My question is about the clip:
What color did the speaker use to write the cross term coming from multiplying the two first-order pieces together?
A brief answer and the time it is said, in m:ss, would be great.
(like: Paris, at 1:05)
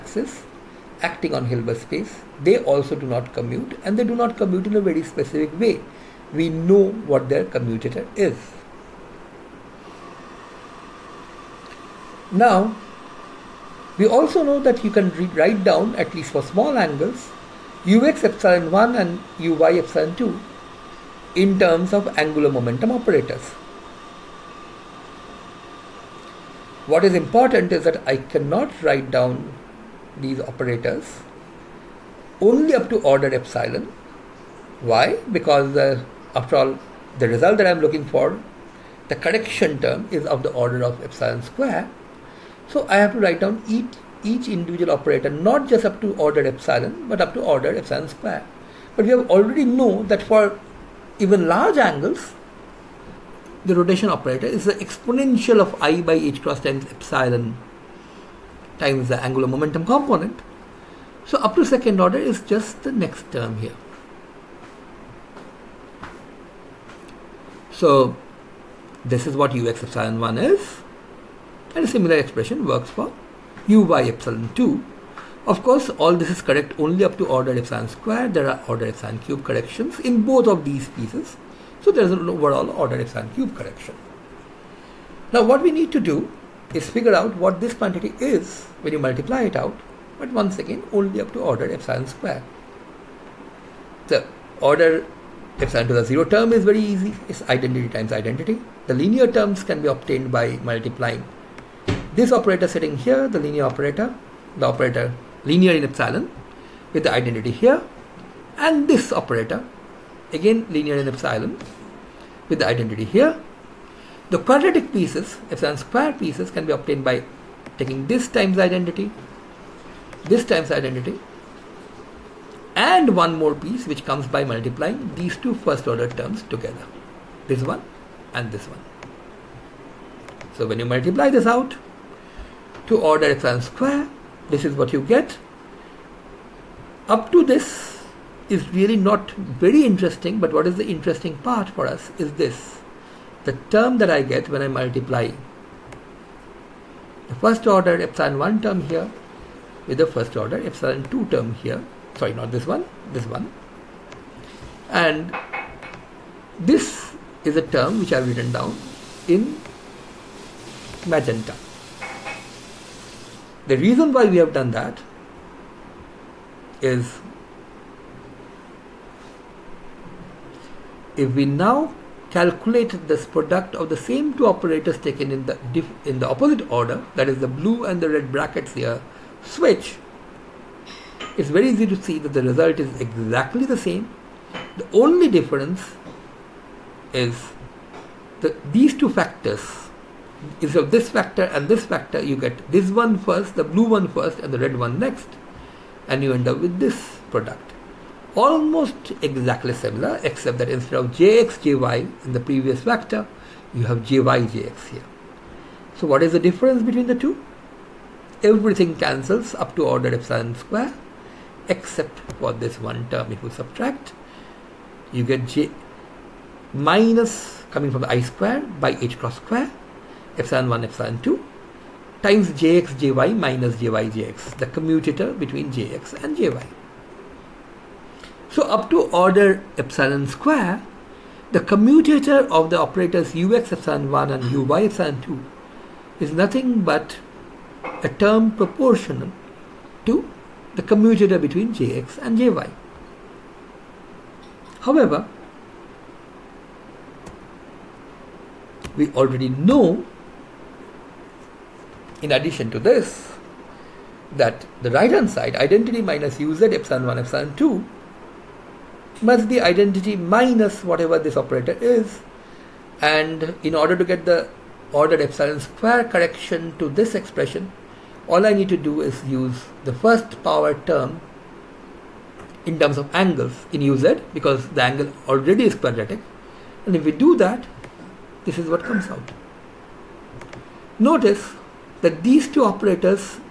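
magenta, at 2:41.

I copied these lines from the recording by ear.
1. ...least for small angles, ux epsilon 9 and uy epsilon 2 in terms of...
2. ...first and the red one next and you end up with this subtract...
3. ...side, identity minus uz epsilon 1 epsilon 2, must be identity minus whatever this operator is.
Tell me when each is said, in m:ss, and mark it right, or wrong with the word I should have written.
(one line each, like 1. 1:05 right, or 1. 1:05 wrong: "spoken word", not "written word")
1. 0:16 wrong: "1", not "9"
2. 3:14 wrong: "product", not "subtract"
3. 4:15 right.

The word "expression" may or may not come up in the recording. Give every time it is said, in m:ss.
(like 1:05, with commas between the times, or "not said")
1:12, 4:27.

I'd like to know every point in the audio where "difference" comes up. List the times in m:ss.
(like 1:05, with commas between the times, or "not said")
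3:05, 3:26.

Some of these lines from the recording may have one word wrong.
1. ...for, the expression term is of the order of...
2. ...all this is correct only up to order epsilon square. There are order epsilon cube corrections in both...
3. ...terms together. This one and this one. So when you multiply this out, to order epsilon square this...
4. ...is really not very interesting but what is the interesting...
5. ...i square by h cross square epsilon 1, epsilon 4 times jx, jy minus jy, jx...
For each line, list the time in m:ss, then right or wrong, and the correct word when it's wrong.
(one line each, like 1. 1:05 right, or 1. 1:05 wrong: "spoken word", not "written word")
1. 0:38 wrong: "correction", not "expression"
2. 1:15 right
3. 2:06 right
4. 2:18 right
5. 3:38 wrong: "2", not "4".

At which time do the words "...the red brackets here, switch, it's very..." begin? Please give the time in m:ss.
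2:57.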